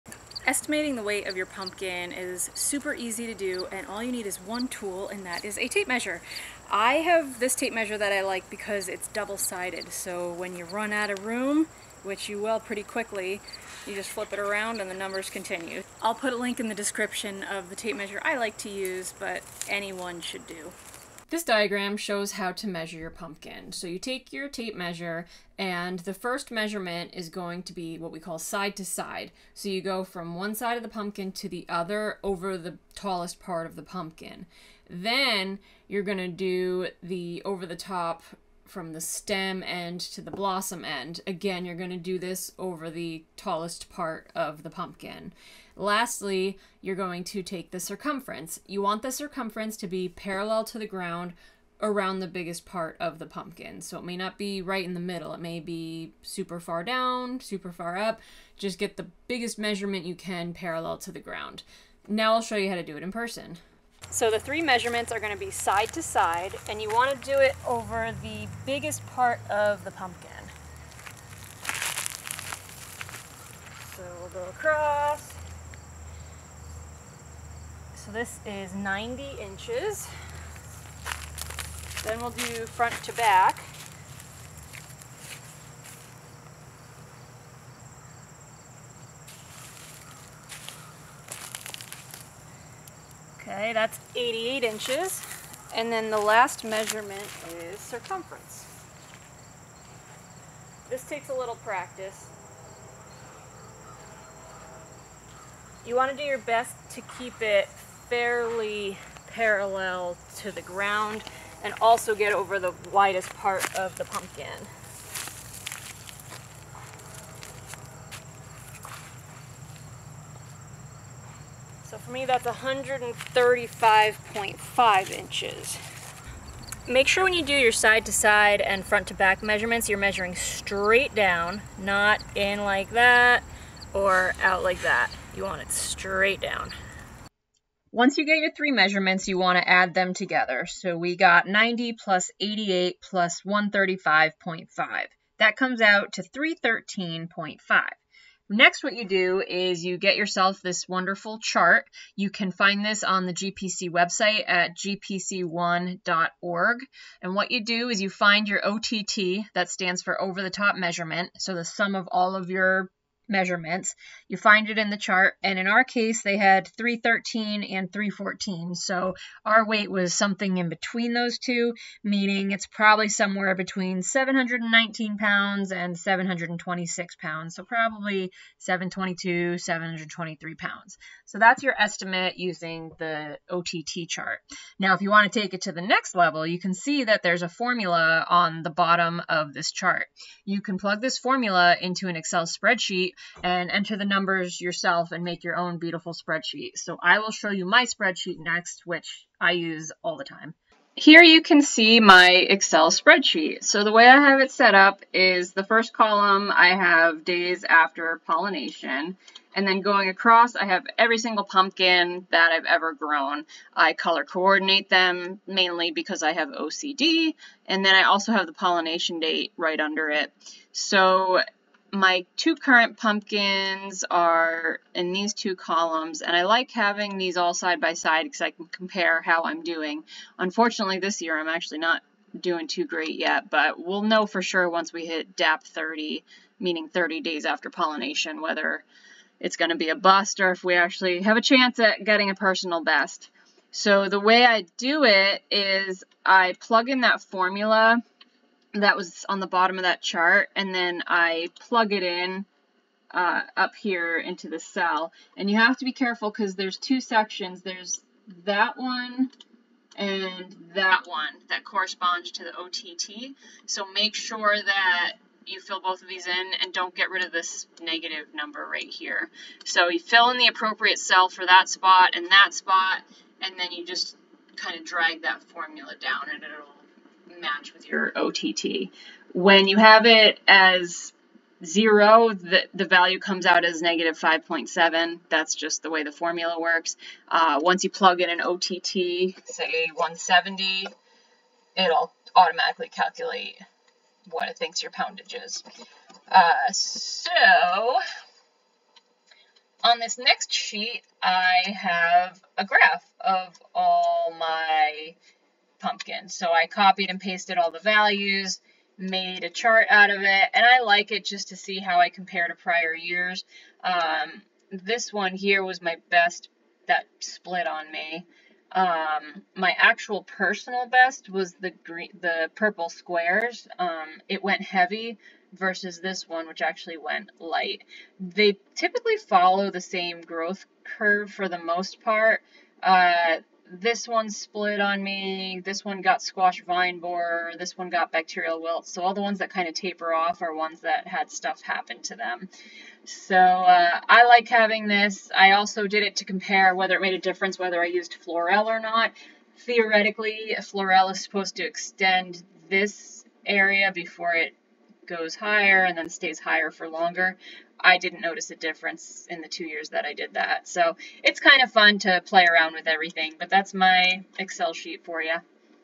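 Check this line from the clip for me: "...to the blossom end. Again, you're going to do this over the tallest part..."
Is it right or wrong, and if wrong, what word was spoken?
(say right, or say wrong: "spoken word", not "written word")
right.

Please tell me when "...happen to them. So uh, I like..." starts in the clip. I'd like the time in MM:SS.
05:41.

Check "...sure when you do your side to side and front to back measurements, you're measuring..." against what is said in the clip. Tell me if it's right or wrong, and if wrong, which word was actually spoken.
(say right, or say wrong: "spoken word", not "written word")
right.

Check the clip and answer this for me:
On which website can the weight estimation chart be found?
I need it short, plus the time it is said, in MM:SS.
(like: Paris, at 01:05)
gpc1.org, at 02:34.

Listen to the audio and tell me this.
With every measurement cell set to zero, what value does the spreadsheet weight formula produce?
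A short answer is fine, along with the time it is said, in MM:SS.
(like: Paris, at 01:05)
-5.7, at 04:43.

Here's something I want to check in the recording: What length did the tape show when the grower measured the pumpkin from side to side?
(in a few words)
90 inches.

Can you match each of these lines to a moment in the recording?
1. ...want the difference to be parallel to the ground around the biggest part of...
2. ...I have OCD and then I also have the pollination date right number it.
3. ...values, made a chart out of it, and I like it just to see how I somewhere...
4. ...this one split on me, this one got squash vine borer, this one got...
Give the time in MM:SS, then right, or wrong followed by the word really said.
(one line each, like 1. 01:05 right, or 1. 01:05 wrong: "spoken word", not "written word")
1. 00:48 wrong: "circumference", not "difference"
2. 03:36 wrong: "under", not "number"
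3. 05:07 wrong: "compare", not "somewhere"
4. 05:33 right.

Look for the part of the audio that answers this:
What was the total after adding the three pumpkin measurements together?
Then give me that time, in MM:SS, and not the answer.
02:26.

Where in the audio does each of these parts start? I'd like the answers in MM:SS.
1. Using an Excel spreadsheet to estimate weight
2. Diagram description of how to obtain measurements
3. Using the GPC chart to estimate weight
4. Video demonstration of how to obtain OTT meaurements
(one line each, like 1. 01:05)
1. 03:04
2. 00:20
3. 02:17
4. 01:03.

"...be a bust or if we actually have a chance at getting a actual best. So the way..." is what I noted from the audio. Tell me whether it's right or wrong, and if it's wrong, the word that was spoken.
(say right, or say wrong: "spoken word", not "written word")
wrong: "personal", not "actual".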